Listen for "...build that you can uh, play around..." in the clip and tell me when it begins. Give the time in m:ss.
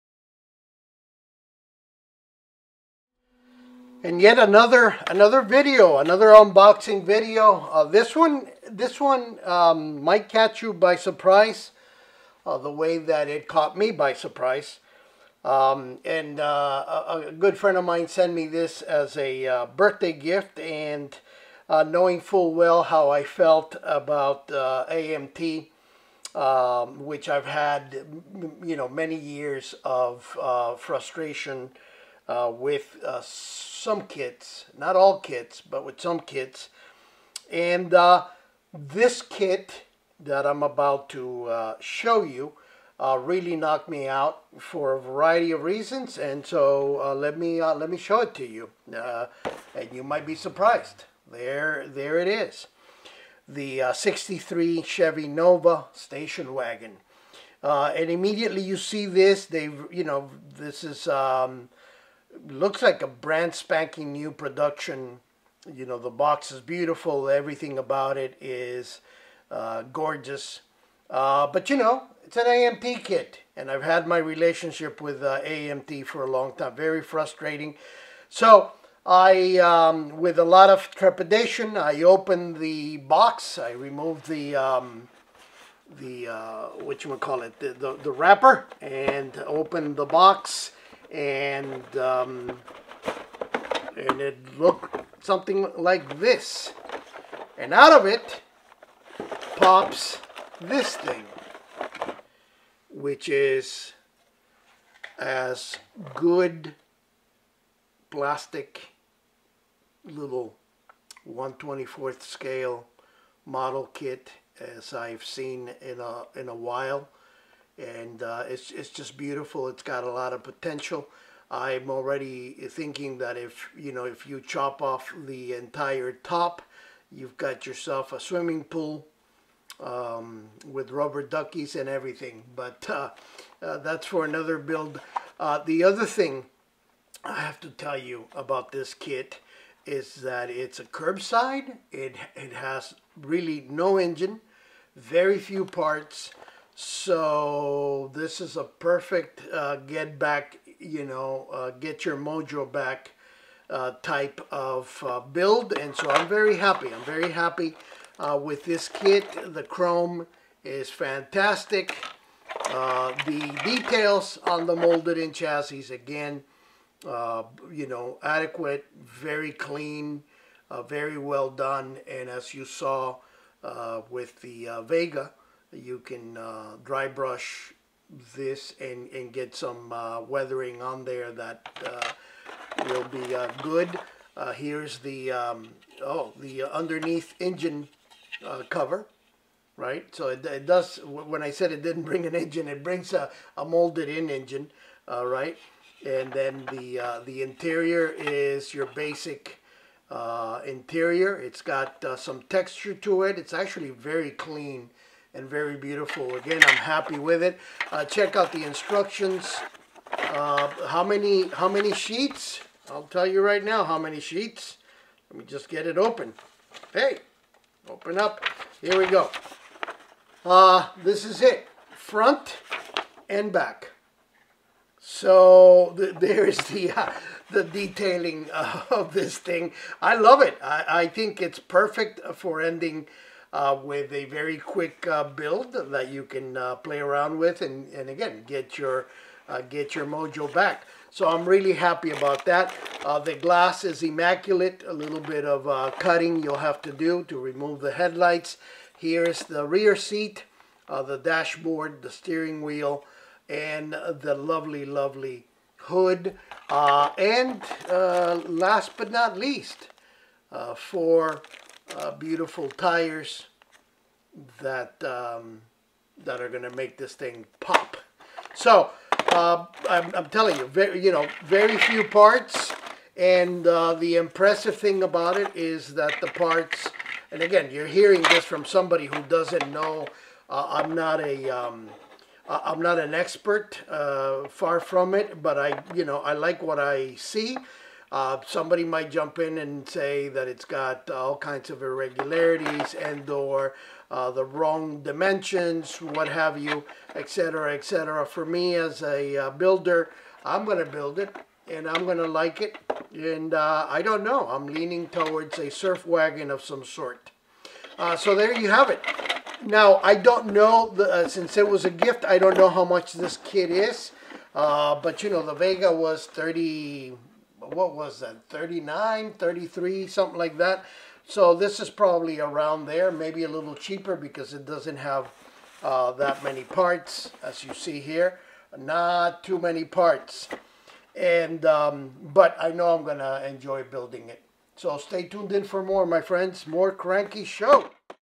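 3:55.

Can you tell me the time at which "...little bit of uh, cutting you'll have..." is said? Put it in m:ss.
4:04.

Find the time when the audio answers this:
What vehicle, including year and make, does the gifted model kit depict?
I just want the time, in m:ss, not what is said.
0:53.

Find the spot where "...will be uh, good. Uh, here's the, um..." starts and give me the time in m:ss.
3:02.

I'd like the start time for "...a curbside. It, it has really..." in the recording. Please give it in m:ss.
2:20.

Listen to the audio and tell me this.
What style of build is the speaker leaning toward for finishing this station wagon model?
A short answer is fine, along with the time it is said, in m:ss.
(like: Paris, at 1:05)
A surf wagon, at 5:05.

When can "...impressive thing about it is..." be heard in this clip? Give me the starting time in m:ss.
4:34.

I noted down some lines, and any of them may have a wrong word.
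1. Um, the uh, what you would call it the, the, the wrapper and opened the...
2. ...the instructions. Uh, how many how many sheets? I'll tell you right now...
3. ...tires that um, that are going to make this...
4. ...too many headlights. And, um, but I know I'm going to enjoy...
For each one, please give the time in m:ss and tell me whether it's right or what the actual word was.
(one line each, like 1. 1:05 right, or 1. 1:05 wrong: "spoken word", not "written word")
1. 1:24 right
2. 3:28 right
3. 4:22 right
4. 5:29 wrong: "parts", not "headlights".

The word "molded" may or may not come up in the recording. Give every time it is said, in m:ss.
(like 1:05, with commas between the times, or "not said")
2:44, 3:13.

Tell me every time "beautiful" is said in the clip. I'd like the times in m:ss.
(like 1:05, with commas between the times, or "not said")
1:06, 1:59, 3:25, 4:22.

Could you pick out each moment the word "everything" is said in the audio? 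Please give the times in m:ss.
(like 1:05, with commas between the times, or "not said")
1:07, 2:11.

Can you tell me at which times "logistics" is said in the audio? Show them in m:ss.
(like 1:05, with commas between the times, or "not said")
not said.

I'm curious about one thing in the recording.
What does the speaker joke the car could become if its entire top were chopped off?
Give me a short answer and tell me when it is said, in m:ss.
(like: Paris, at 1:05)
A swimming pool, at 2:08.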